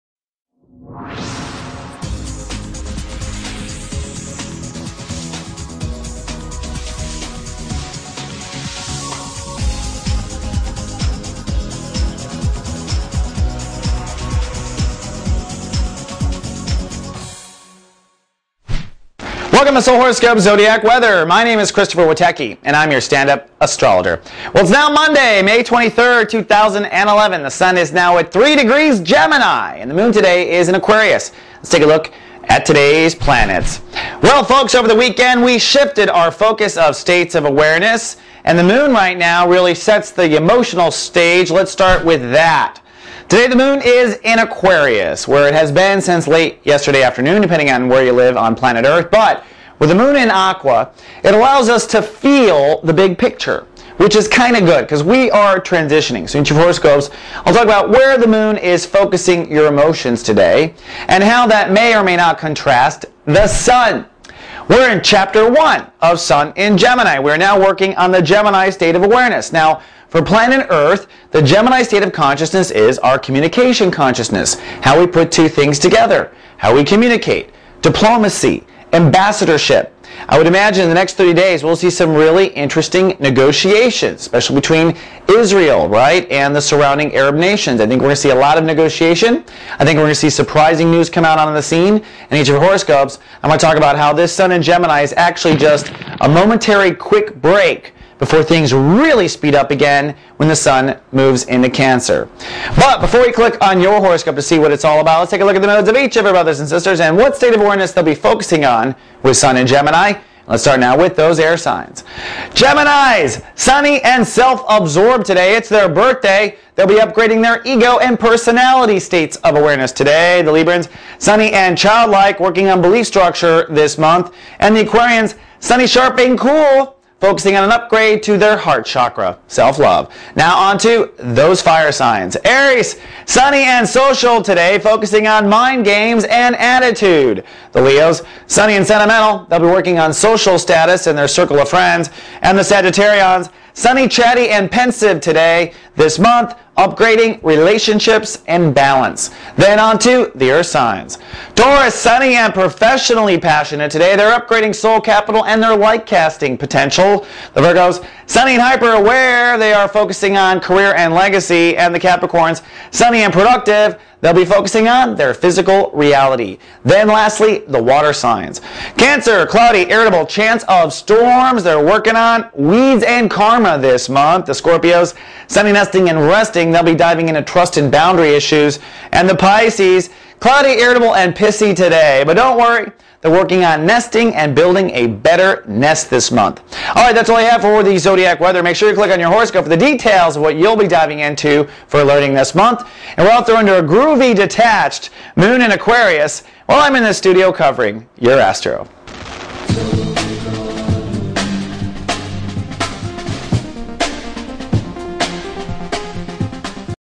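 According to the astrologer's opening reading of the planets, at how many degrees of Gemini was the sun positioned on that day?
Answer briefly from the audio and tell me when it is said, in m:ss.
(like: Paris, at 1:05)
3, at 0:28.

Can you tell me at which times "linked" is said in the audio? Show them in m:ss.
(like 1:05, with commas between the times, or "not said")
not said.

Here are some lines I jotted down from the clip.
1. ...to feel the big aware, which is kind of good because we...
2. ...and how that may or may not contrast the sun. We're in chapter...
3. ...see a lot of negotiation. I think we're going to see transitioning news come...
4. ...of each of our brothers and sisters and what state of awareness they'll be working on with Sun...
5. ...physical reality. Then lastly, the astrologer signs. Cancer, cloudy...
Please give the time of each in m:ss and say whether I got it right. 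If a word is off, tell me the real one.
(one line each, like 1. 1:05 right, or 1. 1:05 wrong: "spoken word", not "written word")
1. 0:51 wrong: "picture", not "aware"
2. 1:01 right
3. 1:28 wrong: "surprising", not "transitioning"
4. 1:45 wrong: "focusing", not "working"
5. 2:45 wrong: "water", not "astrologer".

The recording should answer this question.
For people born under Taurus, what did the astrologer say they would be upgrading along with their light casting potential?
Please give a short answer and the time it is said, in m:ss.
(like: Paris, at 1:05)
Soul capital, at 2:34.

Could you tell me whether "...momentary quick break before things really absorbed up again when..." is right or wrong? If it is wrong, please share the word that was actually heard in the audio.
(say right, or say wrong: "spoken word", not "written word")
wrong: "speed", not "absorbed".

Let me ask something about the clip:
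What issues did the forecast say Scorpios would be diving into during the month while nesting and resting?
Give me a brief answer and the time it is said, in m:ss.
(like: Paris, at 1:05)
Trust and boundary issues, at 2:57.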